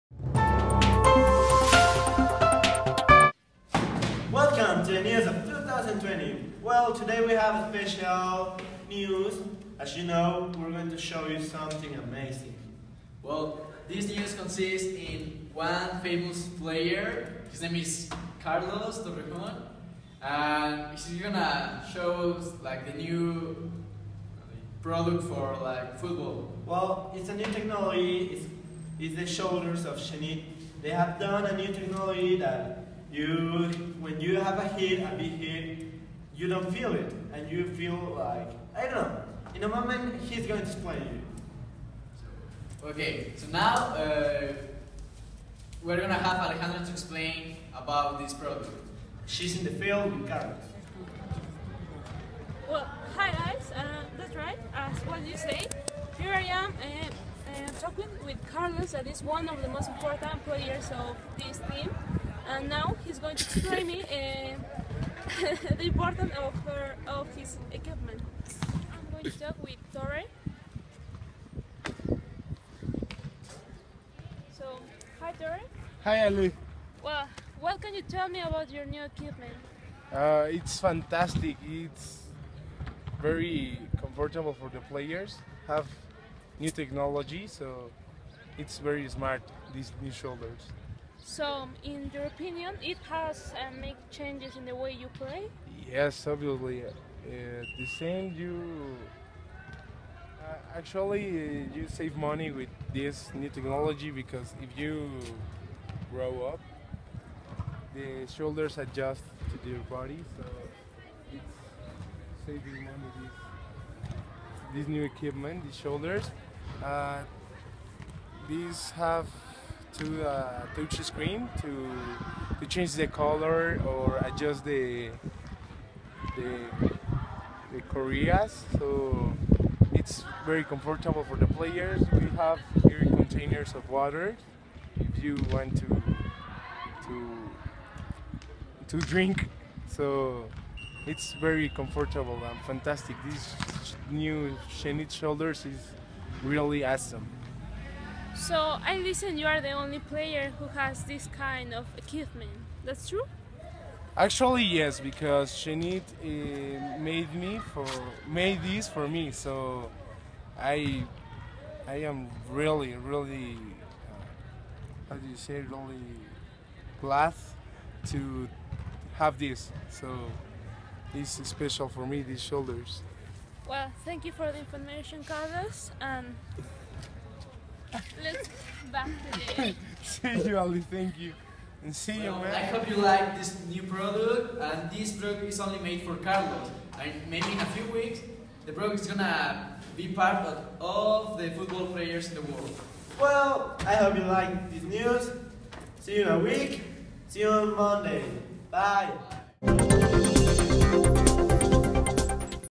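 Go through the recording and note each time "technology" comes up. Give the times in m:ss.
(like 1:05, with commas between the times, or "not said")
0:27, 0:31, 1:26, 1:43.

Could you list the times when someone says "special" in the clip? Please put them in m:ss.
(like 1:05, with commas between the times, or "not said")
0:07, 2:51.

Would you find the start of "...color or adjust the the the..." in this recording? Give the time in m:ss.
2:03.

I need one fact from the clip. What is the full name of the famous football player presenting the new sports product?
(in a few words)
Carlos Torrejon.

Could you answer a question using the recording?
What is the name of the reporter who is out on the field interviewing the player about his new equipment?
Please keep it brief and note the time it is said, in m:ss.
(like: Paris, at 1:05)
Alejandra, at 0:46.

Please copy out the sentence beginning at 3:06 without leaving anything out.
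And maybe in a few weeks, the product is gonna be part of all the football players in the world.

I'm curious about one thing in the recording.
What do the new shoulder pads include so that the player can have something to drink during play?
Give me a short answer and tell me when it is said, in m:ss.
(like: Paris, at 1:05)
containers of water, at 2:13.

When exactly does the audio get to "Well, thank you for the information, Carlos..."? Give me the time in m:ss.
2:53.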